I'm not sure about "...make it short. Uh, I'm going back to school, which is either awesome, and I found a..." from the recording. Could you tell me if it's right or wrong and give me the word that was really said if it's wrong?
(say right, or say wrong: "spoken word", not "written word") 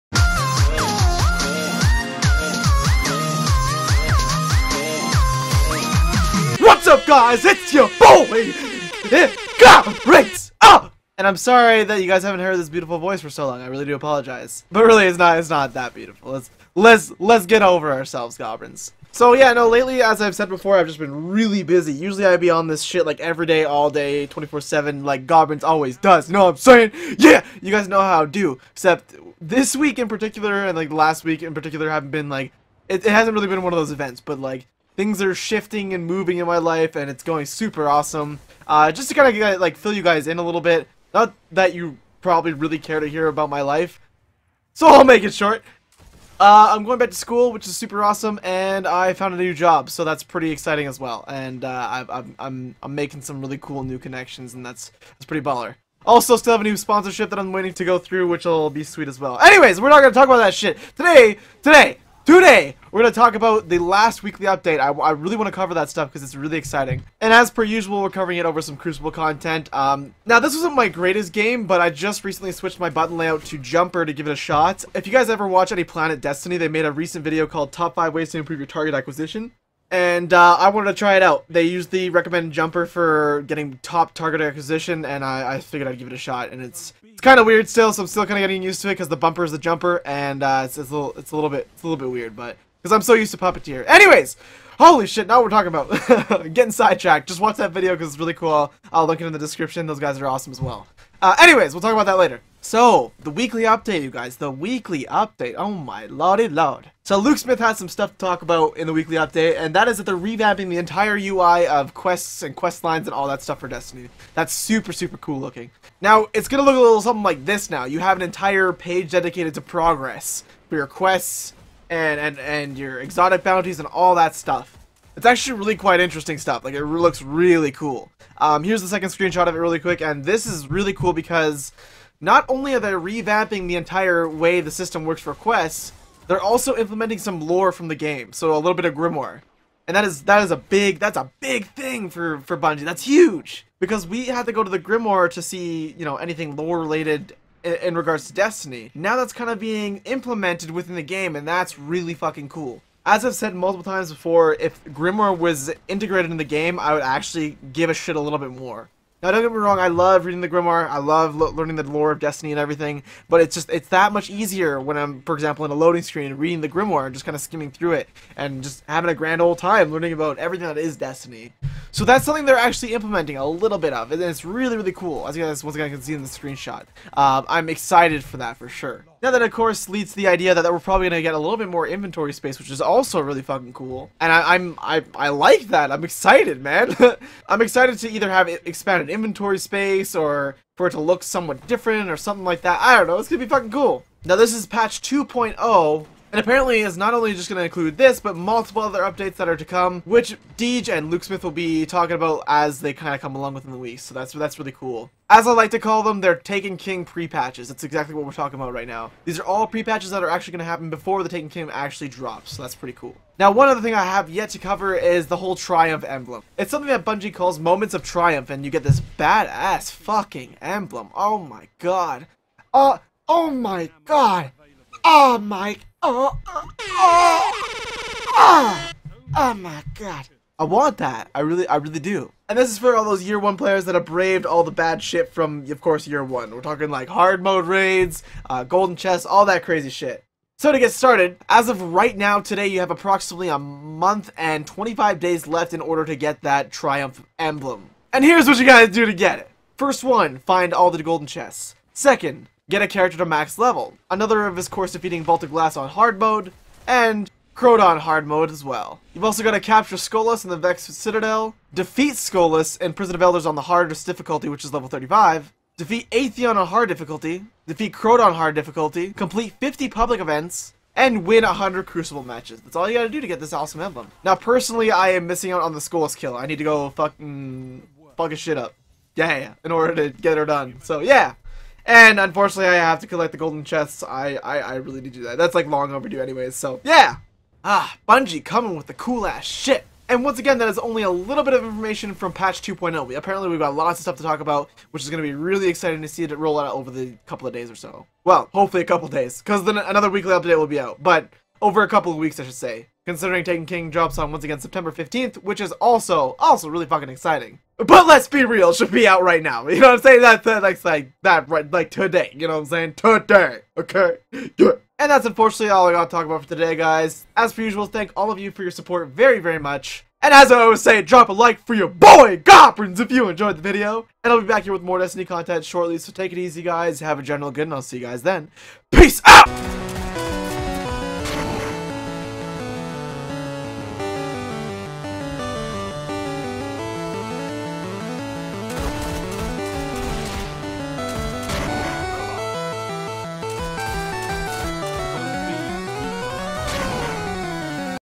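wrong: "super", not "either".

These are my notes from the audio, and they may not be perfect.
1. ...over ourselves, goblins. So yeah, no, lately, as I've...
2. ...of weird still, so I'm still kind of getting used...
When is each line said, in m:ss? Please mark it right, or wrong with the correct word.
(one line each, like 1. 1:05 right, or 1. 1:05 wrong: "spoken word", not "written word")
1. 0:17 right
2. 1:27 right.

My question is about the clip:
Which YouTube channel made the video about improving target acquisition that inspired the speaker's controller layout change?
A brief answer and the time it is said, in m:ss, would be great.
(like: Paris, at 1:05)
Planet Destiny, at 1:15.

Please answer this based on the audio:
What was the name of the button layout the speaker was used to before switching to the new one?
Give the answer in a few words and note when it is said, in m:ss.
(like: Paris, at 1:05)
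Puppeteer, at 1:33.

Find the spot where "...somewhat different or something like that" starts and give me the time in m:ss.
3:11.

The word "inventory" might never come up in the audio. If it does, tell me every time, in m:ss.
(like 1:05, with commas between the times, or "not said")
3:01, 3:09.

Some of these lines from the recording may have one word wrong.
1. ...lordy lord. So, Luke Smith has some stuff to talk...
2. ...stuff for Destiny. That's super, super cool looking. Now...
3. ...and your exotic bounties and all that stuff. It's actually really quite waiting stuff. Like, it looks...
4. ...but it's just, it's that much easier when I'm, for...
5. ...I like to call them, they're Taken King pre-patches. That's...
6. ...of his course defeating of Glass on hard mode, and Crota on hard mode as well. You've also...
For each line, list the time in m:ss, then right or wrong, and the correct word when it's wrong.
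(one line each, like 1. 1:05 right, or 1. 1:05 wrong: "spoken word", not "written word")
1. 1:46 right
2. 1:53 right
3. 2:02 wrong: "interesting", not "waiting"
4. 2:43 right
5. 3:25 right
6. 4:14 right.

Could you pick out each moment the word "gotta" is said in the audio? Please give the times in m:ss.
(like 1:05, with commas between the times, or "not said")
4:08, 4:32.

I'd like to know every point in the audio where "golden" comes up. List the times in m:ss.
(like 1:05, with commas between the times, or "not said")
3:58, 4:11, 4:43.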